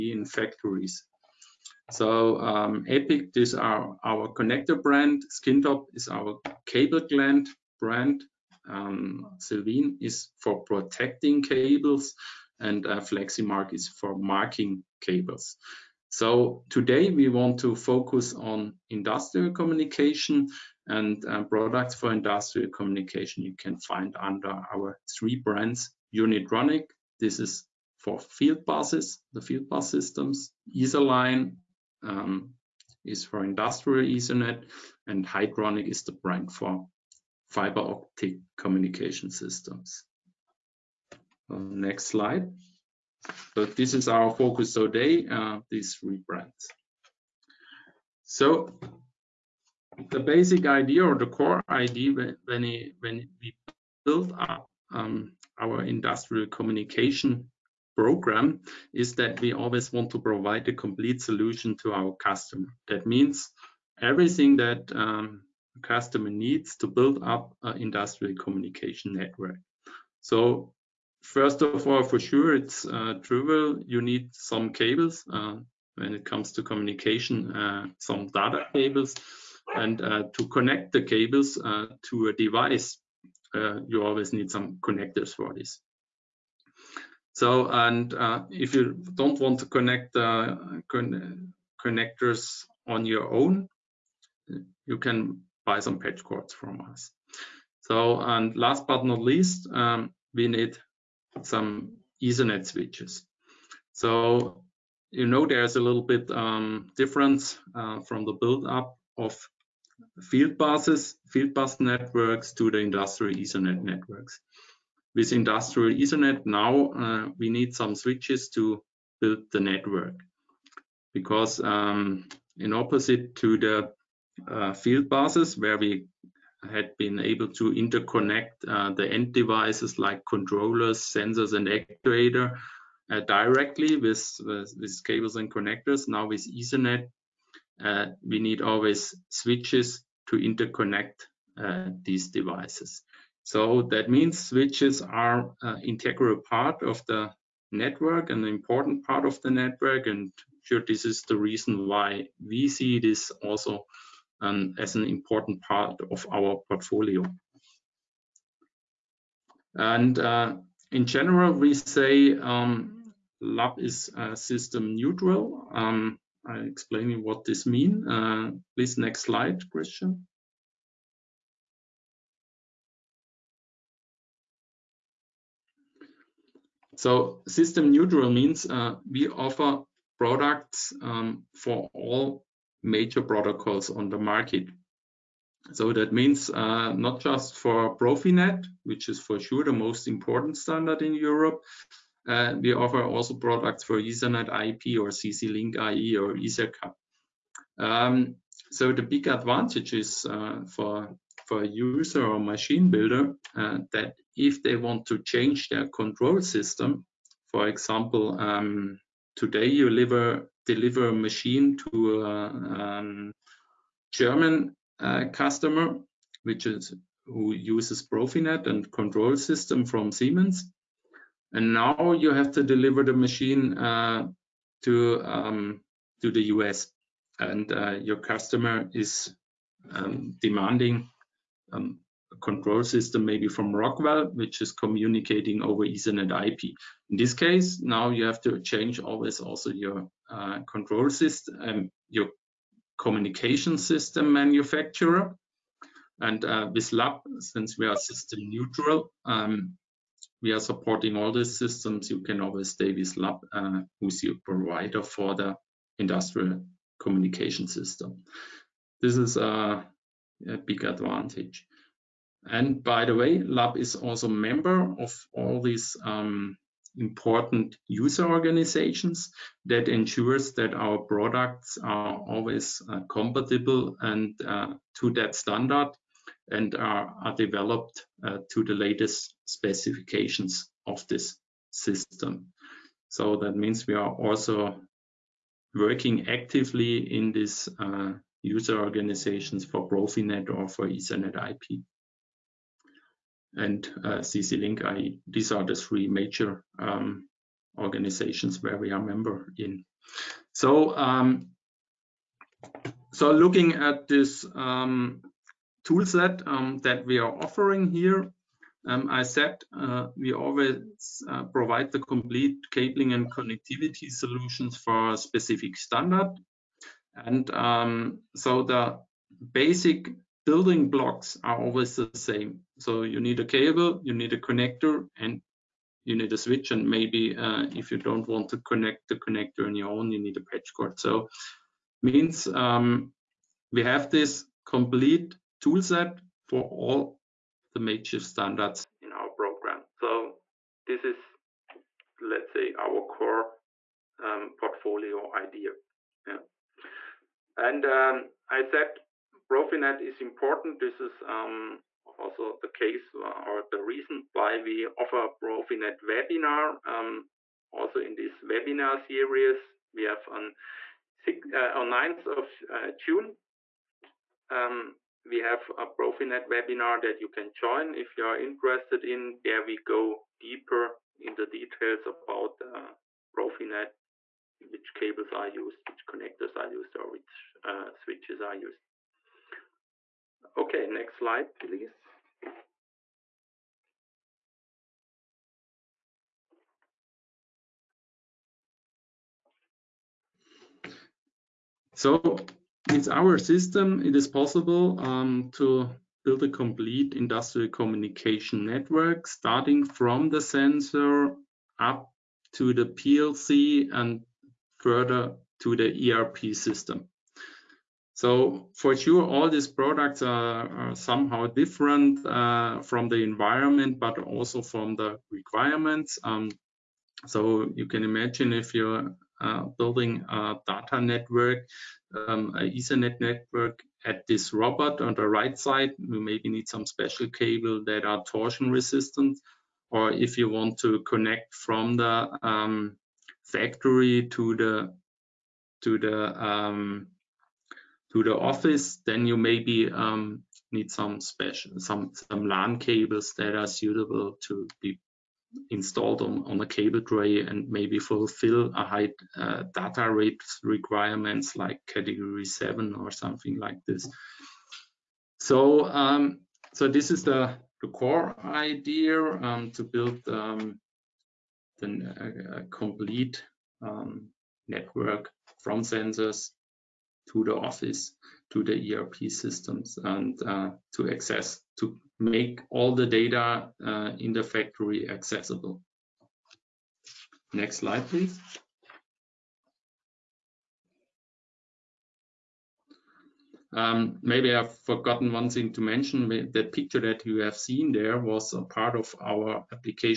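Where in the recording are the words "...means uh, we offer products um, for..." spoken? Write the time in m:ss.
2:58.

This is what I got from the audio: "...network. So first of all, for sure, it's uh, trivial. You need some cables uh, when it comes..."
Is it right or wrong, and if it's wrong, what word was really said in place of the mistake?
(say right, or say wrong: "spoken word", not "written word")
right.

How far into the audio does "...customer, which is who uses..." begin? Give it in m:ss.
3:35.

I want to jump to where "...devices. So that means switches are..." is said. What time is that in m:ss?
2:22.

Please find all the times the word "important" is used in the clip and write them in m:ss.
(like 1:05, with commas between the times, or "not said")
2:28, 2:35, 3:10, 4:26, 5:50.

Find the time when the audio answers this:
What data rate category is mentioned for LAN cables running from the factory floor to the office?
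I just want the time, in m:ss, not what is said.
7:31.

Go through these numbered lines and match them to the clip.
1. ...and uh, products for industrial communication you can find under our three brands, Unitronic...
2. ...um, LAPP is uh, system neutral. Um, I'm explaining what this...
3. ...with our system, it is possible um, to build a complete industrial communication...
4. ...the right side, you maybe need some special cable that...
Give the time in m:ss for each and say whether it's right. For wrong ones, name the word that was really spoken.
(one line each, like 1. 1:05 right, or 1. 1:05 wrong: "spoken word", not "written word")
1. 0:20 right
2. 2:42 right
3. 6:32 right
4. 7:05 right.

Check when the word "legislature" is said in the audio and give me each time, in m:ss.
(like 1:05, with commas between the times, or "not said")
not said.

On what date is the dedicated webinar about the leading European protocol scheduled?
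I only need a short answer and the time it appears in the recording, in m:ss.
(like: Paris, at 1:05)
9 June, at 6:01.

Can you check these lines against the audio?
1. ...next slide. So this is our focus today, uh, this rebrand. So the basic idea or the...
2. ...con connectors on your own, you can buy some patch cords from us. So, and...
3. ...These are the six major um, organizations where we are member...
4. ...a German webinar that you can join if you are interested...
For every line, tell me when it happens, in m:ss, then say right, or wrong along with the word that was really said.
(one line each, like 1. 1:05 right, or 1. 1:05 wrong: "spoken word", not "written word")
1. 0:41 right
2. 1:30 right
3. 4:55 wrong: "three", not "six"
4. 6:05 wrong: "Profinet", not "German".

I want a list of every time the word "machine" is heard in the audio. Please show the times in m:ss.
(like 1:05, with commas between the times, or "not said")
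3:22, 3:31, 3:43.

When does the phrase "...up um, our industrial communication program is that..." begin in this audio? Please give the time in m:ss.
0:54.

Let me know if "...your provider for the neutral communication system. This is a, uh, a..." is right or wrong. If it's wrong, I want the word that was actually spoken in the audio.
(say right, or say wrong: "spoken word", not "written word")
wrong: "industrial", not "neutral".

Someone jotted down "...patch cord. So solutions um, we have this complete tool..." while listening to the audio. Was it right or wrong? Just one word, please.
wrong.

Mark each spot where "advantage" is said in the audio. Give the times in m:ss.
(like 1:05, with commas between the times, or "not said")
3:19, 4:20.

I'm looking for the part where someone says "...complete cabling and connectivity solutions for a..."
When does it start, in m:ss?
5:12.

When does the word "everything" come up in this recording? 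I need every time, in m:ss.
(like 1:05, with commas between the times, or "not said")
1:04.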